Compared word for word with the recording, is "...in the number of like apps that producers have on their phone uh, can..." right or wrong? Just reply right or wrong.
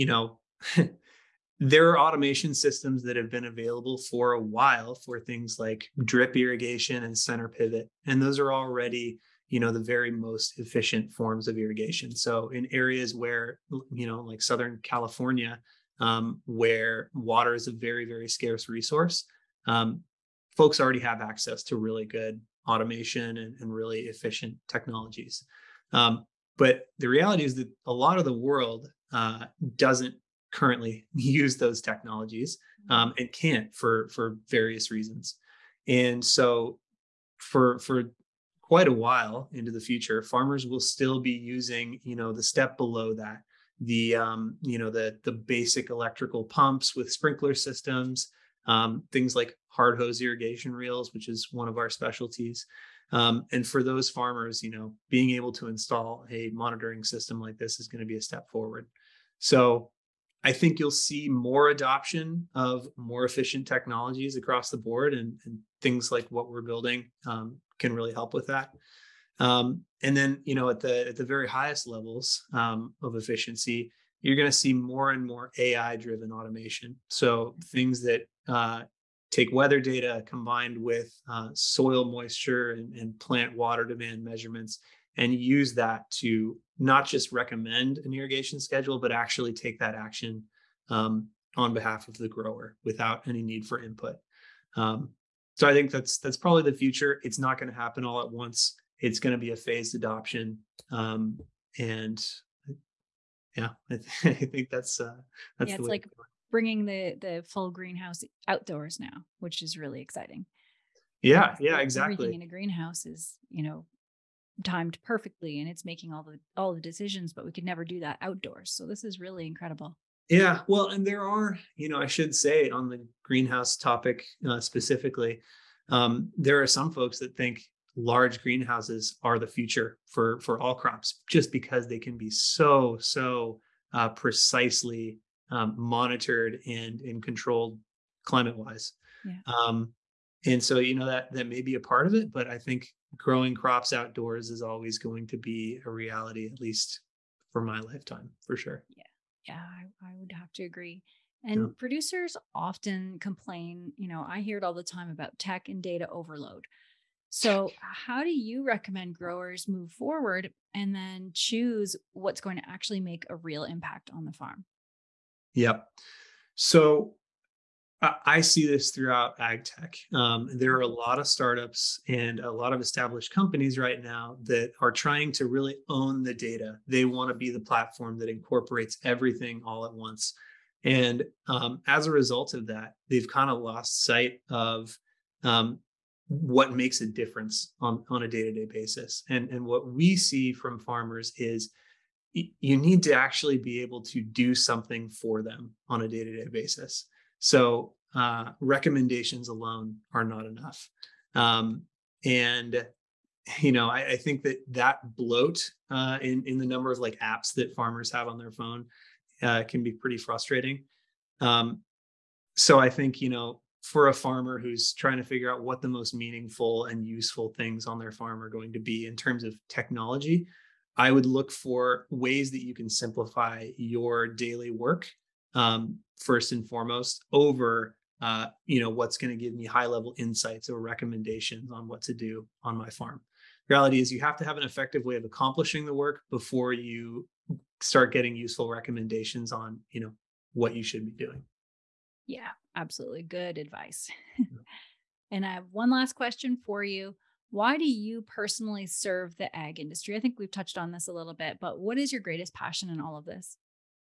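wrong.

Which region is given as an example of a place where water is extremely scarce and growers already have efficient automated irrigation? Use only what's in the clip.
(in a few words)
Southern California.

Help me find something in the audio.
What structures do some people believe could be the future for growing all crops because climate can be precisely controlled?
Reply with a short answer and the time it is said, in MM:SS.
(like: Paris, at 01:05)
large greenhouses, at 02:07.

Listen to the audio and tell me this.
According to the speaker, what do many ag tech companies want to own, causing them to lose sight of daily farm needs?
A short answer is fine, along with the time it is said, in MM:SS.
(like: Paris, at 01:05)
the data, at 02:56.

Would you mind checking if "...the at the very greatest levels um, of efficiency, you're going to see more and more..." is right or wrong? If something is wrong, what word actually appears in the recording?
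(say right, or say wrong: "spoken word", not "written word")
wrong: "highest", not "greatest".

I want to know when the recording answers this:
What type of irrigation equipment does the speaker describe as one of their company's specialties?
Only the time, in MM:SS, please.
00:49.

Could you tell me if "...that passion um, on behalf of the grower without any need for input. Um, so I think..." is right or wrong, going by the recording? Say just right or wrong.
wrong.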